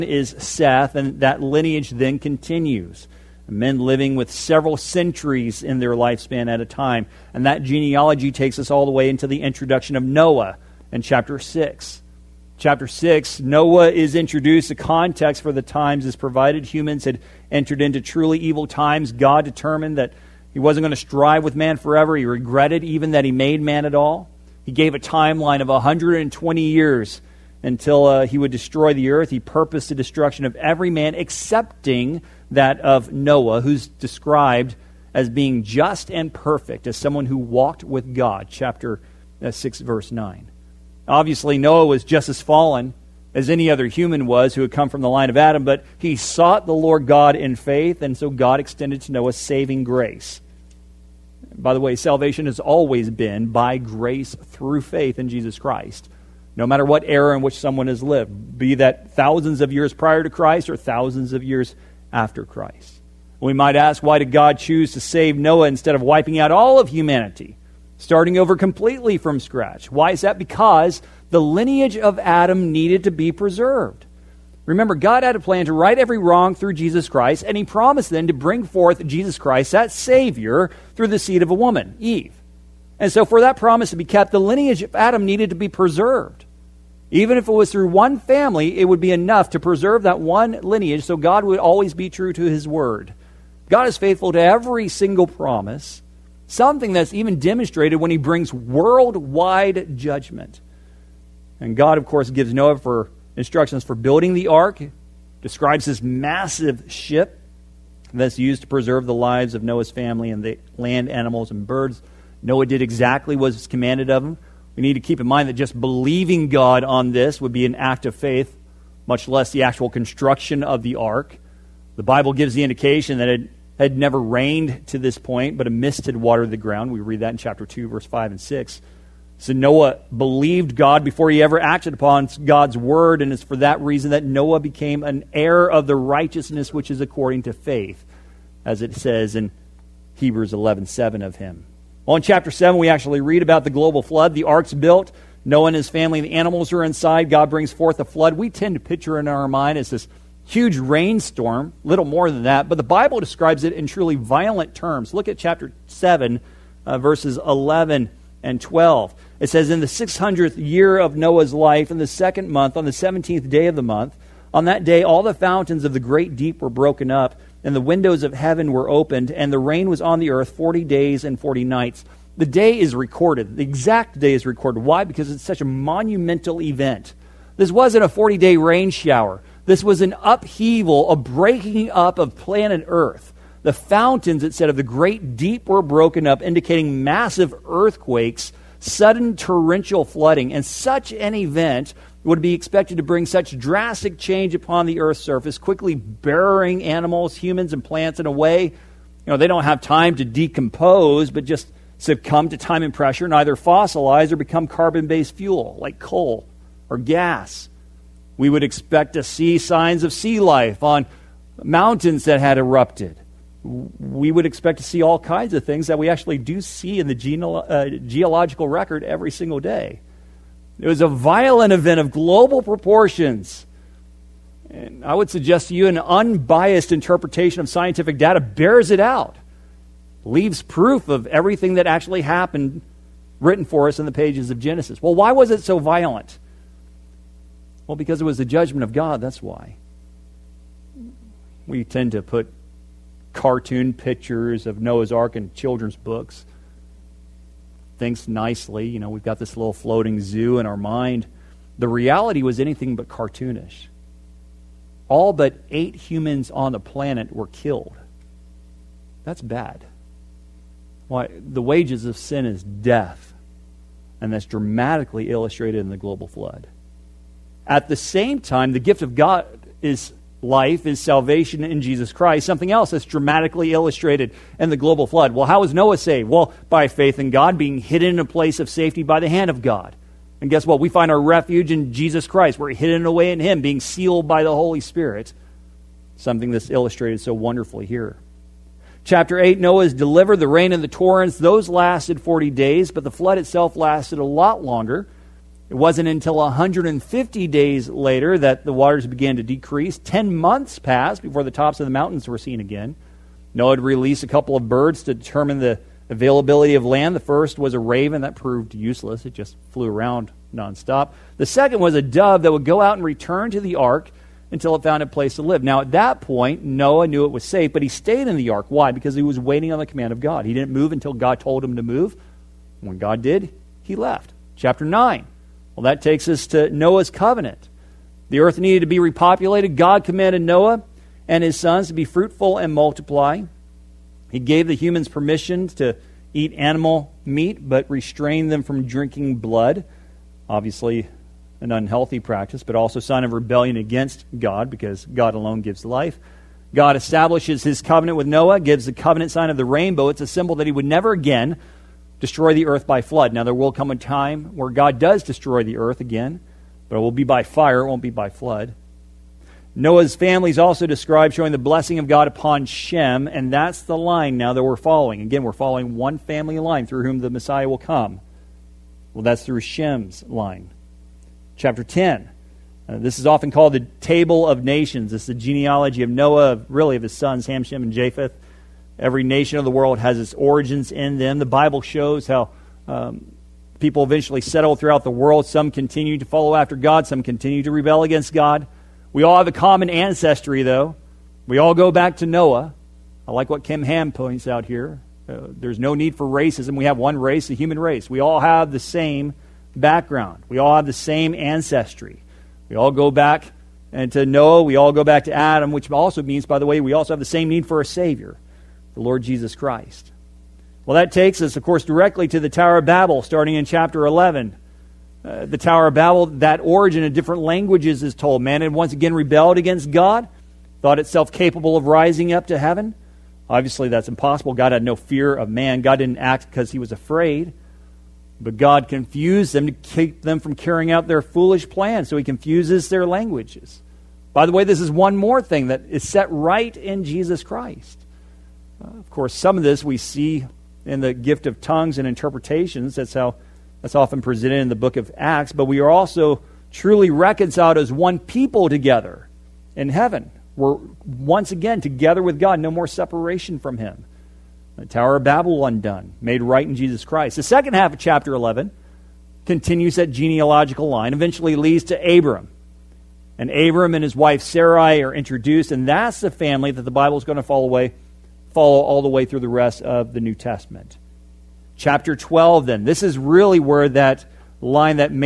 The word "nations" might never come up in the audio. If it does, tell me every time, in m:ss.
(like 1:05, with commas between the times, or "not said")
6:14, 6:19.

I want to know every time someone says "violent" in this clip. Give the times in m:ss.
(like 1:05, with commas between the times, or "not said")
2:34, 3:41, 3:55.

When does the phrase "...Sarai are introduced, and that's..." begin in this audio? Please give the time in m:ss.
7:44.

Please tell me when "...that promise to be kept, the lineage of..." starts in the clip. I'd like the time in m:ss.
1:23.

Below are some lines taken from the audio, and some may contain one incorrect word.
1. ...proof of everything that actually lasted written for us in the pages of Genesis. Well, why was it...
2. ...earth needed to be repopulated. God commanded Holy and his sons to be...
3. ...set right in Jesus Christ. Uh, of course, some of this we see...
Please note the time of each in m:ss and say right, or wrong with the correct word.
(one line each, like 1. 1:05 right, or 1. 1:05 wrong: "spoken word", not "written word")
1. 3:50 wrong: "happened", not "lasted"
2. 5:28 wrong: "Noah", not "Holy"
3. 7:16 right.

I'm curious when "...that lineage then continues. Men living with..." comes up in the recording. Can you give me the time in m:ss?
0:01.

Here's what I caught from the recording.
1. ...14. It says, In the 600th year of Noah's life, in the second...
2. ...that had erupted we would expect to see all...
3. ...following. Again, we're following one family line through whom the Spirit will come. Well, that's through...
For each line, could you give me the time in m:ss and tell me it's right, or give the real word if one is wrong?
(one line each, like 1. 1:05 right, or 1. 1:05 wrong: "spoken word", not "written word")
1. 2:38 wrong: "12", not "14"
2. 3:32 right
3. 6:04 wrong: "Messiah", not "Spirit".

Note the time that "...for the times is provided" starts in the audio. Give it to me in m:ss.
0:15.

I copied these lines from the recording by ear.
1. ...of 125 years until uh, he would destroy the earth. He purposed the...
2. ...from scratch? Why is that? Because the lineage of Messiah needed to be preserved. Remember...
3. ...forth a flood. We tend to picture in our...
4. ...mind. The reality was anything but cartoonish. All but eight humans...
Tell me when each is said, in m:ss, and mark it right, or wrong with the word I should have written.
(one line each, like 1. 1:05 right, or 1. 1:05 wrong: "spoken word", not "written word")
1. 0:25 wrong: "120", not "125"
2. 1:09 wrong: "Adam", not "Messiah"
3. 2:27 right
4. 4:10 right.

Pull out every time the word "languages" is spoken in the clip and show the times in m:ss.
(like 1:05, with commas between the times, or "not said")
6:57, 7:13.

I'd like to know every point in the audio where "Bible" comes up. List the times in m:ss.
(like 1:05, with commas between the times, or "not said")
2:02, 2:32, 6:21, 7:46.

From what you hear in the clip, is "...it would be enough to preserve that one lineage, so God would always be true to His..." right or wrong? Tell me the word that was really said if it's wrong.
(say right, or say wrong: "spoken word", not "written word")
right.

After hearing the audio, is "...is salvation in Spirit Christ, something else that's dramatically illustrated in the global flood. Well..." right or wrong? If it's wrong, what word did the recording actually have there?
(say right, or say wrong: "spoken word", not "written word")
wrong: "Jesus", not "Spirit".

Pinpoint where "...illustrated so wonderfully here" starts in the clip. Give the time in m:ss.
4:46.